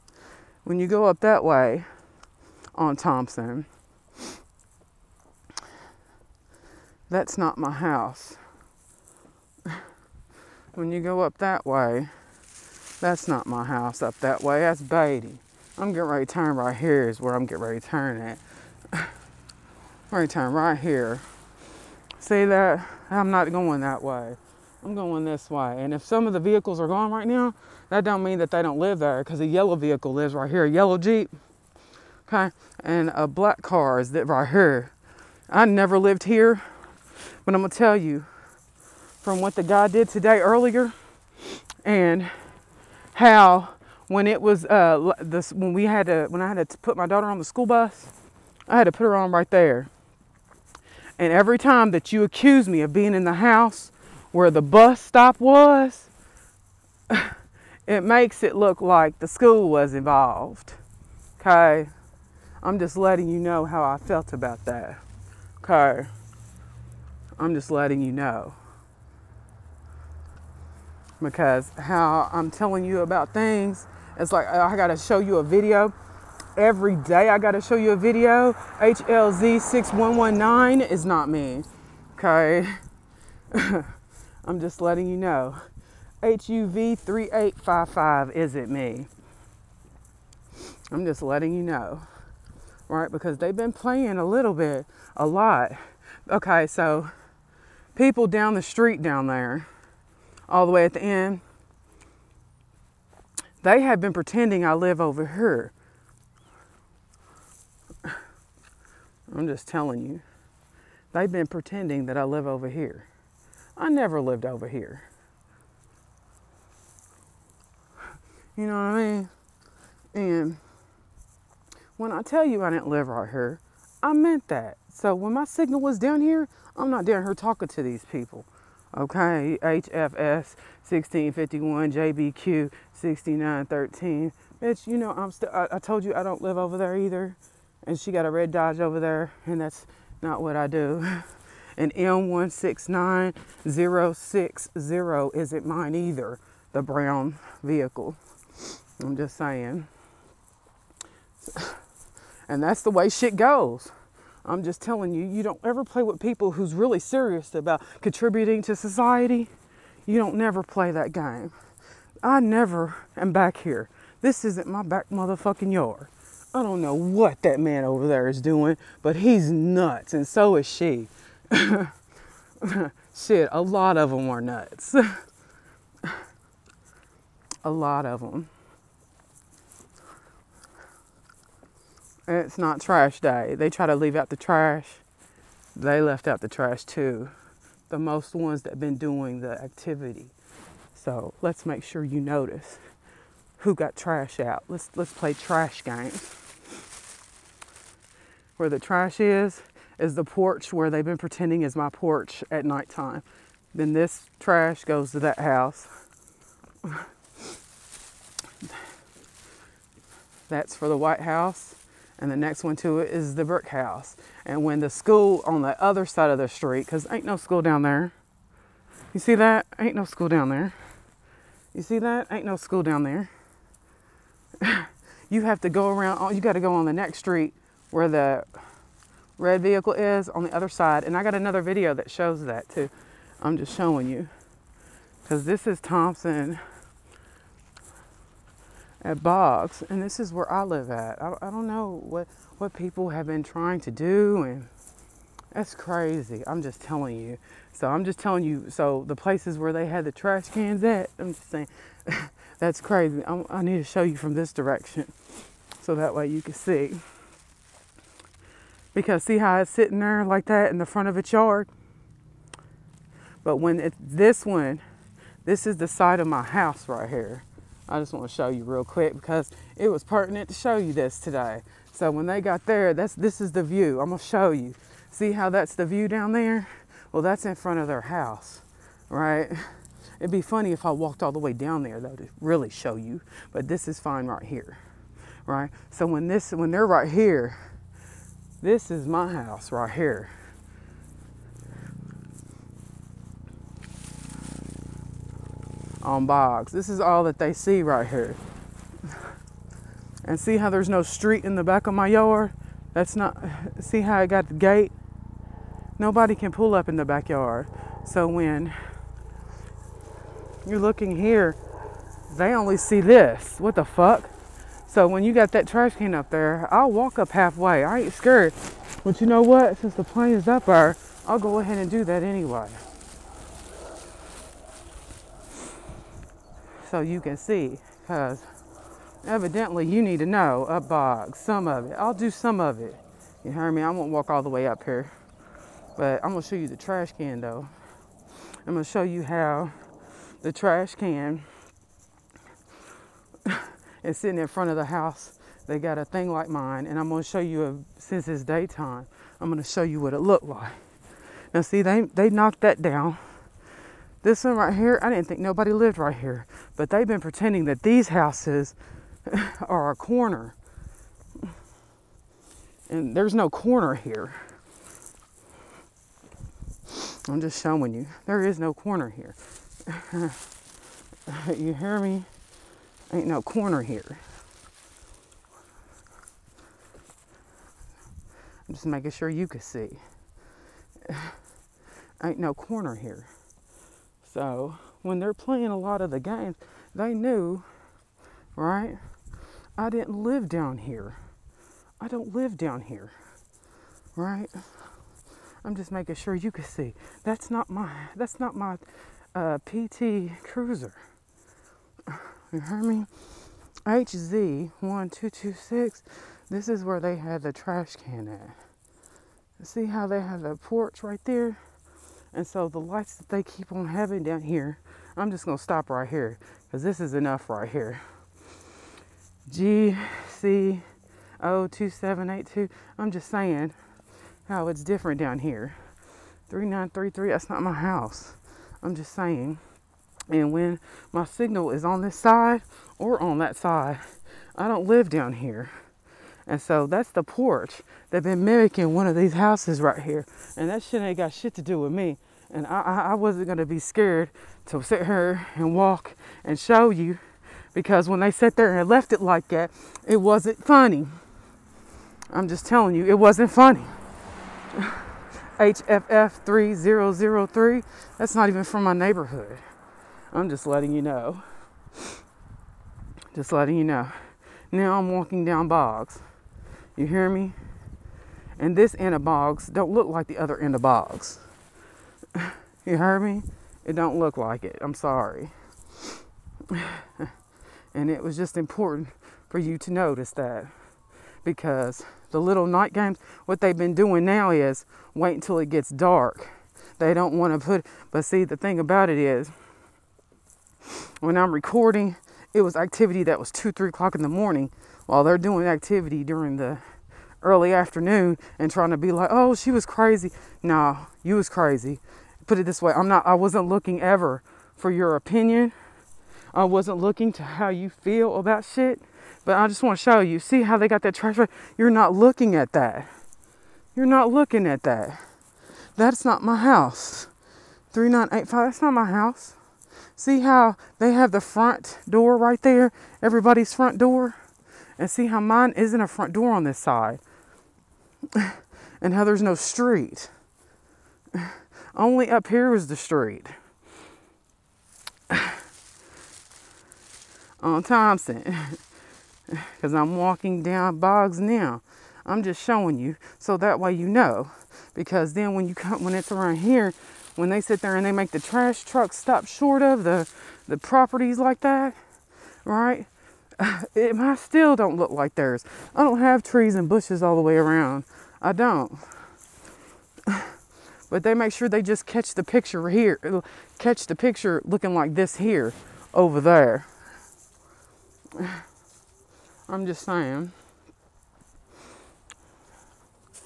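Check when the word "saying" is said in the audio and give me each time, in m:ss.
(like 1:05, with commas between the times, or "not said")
2:29, 4:11, 7:03, 7:09, 9:30.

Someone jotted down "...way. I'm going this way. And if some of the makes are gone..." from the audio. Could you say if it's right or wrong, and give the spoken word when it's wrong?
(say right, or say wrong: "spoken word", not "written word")
wrong: "vehicles", not "makes".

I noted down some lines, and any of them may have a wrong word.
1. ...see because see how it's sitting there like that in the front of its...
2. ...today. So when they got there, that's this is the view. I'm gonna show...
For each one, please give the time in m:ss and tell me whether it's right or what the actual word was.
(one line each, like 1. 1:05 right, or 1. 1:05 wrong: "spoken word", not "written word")
1. 4:16 right
2. 4:31 right.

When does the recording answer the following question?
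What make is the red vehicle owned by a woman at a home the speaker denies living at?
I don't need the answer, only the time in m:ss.
2:18.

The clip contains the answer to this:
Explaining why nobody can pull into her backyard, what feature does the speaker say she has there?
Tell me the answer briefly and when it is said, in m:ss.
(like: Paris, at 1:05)
gate, at 5:04.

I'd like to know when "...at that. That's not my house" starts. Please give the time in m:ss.
8:34.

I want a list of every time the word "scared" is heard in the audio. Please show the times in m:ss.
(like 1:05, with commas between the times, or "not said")
5:18, 7:23.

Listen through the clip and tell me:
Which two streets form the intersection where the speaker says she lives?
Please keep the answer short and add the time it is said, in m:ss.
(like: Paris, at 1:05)
Thompson at Boggs, at 3:55.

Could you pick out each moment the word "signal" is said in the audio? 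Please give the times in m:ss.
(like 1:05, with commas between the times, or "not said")
2:05, 7:11.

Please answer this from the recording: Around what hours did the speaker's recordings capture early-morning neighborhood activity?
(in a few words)
2-3 a.m.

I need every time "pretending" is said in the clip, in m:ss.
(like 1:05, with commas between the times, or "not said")
1:44, 1:51, 3:21, 5:57.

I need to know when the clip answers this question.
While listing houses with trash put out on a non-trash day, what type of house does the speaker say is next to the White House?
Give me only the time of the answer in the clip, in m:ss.
3:33.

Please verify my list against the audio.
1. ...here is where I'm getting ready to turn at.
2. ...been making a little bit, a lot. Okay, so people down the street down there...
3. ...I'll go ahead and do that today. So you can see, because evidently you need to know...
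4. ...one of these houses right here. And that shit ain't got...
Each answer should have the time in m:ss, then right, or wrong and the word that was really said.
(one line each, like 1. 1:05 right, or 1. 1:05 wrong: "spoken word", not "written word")
1. 0:16 right
2. 1:33 wrong: "playing", not "making"
3. 5:21 wrong: "anyway", not "today"
4. 7:18 right.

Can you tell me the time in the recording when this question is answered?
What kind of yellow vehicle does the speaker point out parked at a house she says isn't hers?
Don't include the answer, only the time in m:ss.
0:30.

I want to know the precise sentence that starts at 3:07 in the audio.
The most ones that have been doing the activity.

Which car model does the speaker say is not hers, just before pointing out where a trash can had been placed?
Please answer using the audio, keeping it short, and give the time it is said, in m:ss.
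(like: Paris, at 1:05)
PT Cruiser, at 6:39.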